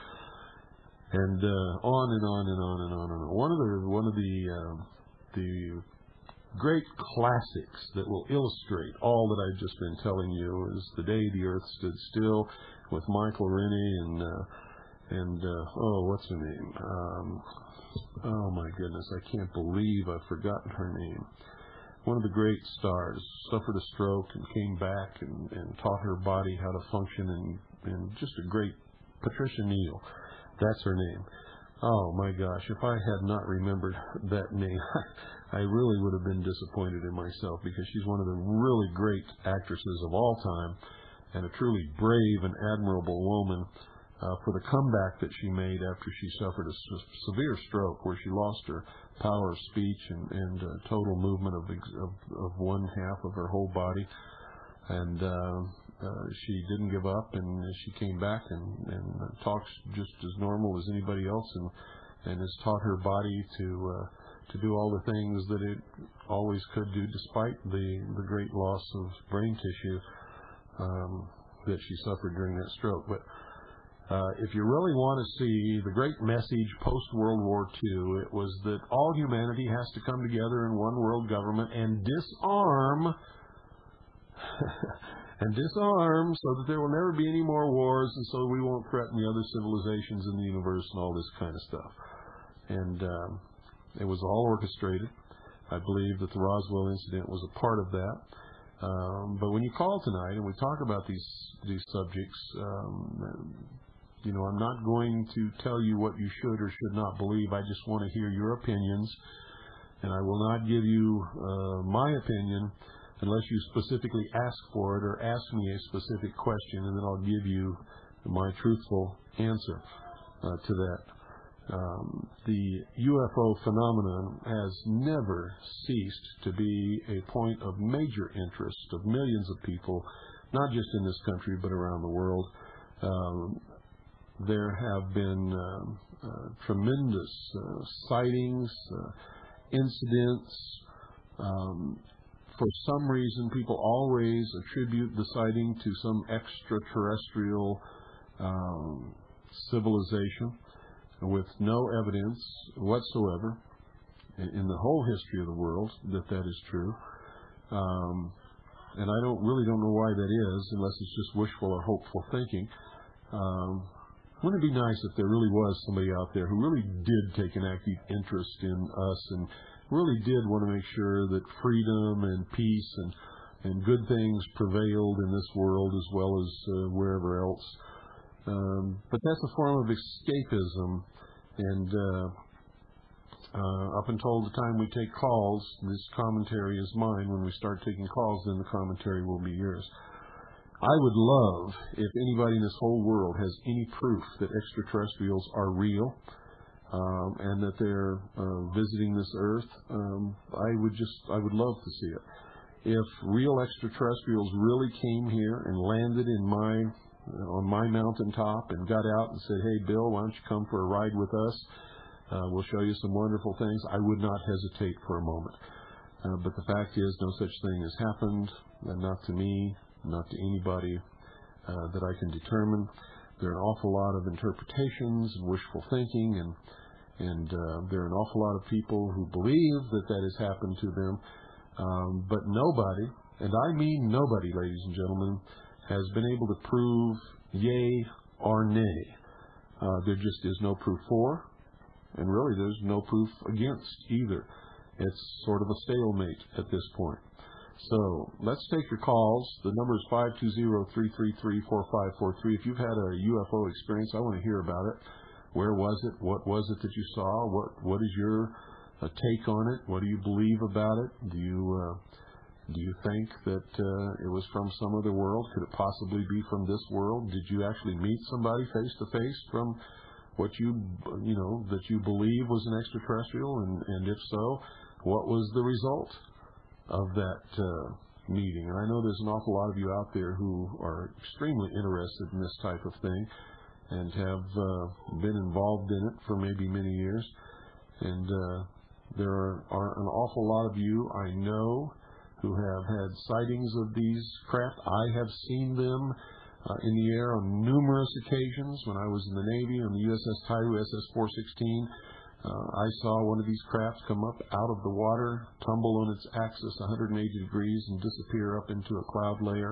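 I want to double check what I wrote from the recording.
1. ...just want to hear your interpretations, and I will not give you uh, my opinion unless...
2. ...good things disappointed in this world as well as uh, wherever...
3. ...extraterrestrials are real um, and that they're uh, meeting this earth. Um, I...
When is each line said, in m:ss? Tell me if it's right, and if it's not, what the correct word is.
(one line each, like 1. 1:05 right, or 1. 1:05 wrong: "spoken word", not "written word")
1. 1:47 wrong: "opinions", not "interpretations"
2. 2:53 wrong: "prevailed", not "disappointed"
3. 3:14 wrong: "visiting", not "meeting".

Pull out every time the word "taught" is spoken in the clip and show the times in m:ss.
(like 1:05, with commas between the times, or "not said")
0:25, 1:02.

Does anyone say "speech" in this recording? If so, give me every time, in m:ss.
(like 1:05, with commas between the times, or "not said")
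0:49.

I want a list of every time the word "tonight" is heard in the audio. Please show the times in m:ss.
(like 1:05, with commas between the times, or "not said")
1:40.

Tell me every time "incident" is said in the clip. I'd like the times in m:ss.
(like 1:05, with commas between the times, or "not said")
1:36, 2:19.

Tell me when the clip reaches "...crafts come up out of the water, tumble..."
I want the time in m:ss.
5:03.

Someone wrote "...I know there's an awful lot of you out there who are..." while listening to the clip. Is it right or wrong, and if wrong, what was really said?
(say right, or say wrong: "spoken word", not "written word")
right.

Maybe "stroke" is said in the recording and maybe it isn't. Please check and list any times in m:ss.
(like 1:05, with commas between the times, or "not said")
0:23, 0:47, 1:12.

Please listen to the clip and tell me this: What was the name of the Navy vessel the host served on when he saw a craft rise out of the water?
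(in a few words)
USS Tiru.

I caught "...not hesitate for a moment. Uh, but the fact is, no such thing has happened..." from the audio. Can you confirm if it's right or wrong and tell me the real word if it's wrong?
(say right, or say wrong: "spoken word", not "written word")
right.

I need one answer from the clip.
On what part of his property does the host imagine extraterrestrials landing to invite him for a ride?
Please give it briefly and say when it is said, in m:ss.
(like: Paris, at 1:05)
mountaintop, at 3:27.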